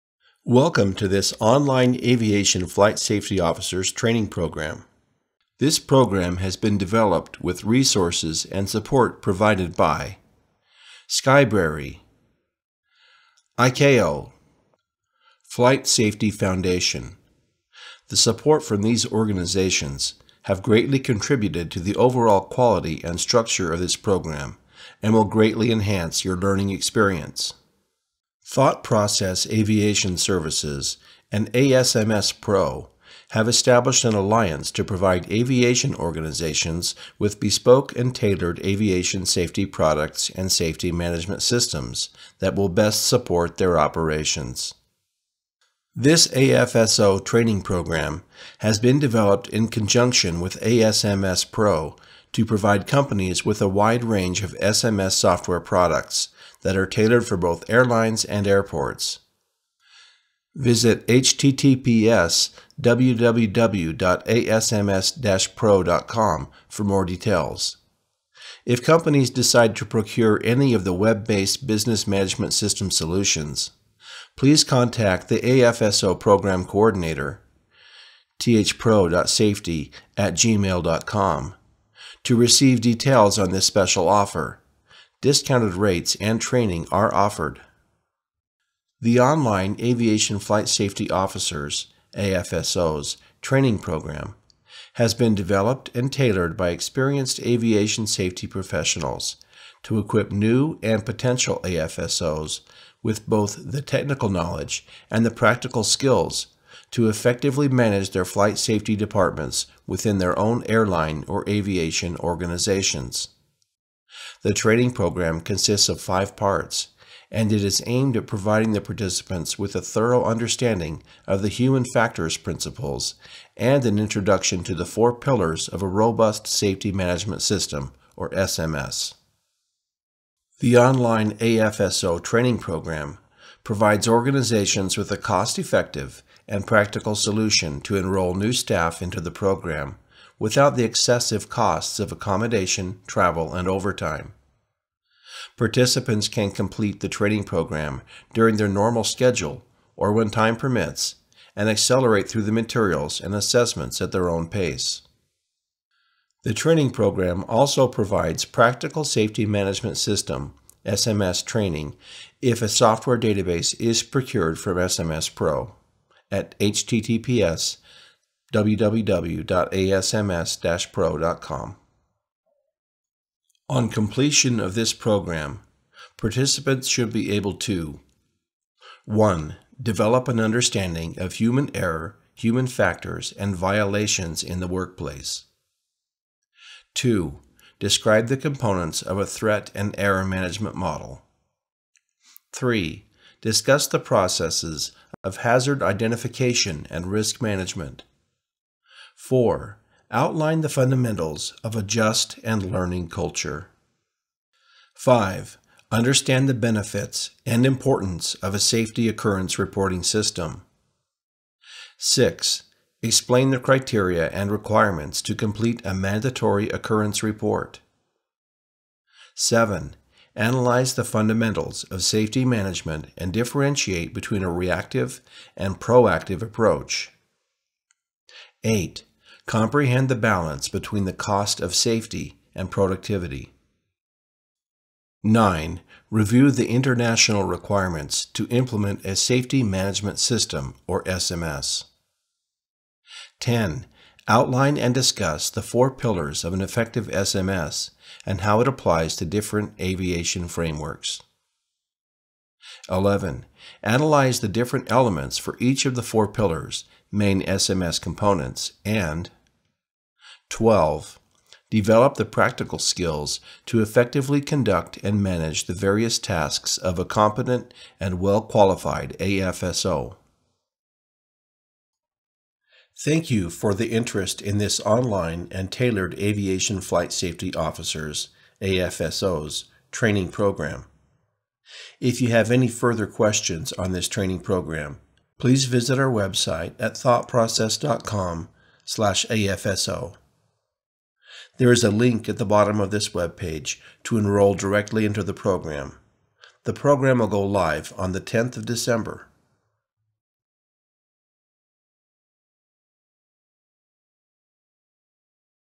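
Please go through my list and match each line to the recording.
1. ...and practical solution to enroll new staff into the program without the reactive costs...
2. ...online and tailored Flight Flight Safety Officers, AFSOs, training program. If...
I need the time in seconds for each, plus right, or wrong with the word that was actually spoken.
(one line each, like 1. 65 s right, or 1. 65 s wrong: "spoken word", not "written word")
1. 136 s wrong: "excessive", not "reactive"
2. 274 s wrong: "Aviation", not "Flight".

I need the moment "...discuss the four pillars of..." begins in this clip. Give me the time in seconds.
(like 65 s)
244 s.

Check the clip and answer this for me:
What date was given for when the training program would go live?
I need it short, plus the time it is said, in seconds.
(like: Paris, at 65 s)
10th of December, at 298 s.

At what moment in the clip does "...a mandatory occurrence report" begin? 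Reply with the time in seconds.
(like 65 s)
215 s.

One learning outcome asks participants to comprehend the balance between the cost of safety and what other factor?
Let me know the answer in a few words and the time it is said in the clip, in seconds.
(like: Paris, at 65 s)
Productivity, at 232 s.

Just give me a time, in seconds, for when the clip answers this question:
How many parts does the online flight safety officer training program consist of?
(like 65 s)
116 s.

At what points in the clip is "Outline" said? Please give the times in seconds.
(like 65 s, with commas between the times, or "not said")
200 s, 244 s.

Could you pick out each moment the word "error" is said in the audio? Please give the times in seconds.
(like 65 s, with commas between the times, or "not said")
181 s, 189 s.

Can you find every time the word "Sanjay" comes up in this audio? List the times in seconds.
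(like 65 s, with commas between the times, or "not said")
not said.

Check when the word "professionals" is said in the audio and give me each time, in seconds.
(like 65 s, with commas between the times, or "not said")
98 s.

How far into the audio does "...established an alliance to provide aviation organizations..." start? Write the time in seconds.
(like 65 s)
33 s.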